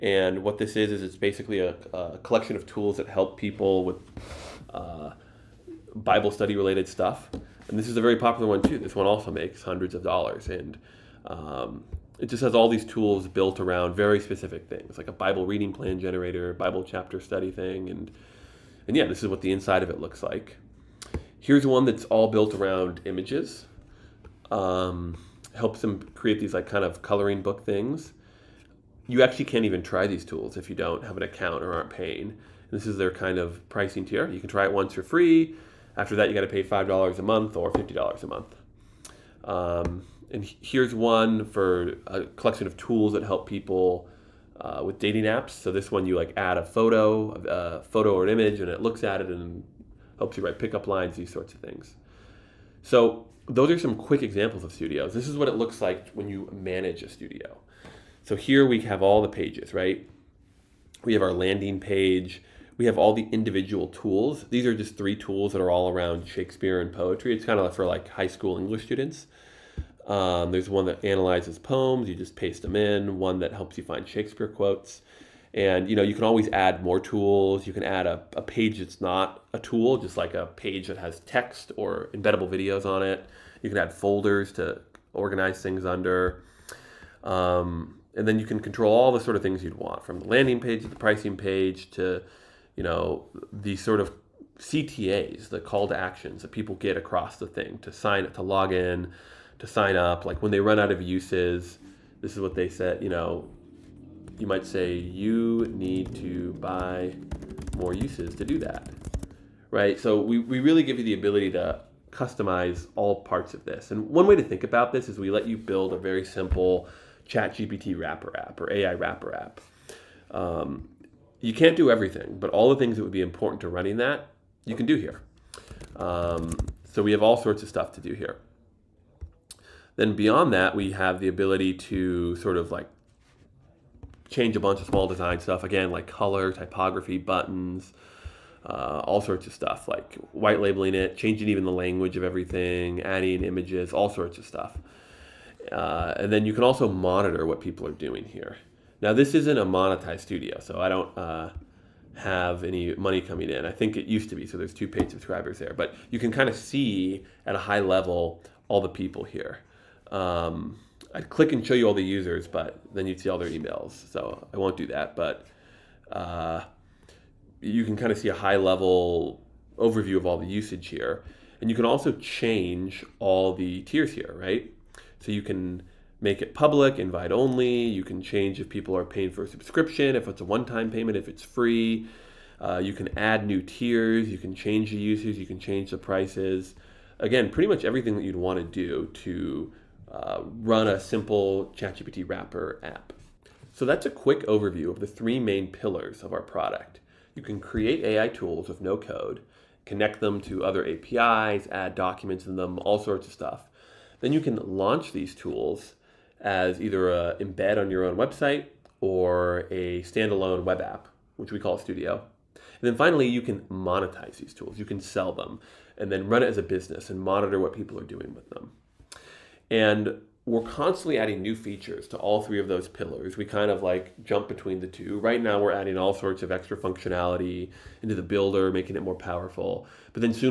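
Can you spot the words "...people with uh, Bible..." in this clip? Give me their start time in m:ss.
0:03.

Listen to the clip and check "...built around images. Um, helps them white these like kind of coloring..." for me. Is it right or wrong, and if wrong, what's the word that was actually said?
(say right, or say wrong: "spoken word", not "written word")
wrong: "create", not "white".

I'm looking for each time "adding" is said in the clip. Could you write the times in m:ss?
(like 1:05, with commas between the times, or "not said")
2:23, 3:41, 3:45.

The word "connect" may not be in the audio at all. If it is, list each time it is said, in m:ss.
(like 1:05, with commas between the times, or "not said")
3:19.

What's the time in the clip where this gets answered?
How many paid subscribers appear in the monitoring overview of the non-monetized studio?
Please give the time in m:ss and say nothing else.
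2:34.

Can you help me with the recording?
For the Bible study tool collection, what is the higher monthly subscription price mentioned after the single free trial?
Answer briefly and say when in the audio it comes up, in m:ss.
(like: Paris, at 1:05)
$50 a month, at 0:37.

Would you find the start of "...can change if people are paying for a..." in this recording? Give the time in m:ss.
2:58.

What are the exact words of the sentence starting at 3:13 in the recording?
So that's a quick overview of the three main pillars of our product.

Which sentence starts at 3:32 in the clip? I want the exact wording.
And then finally, you can monetize these tools.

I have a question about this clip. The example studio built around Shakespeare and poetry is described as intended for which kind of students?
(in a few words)
High school English students.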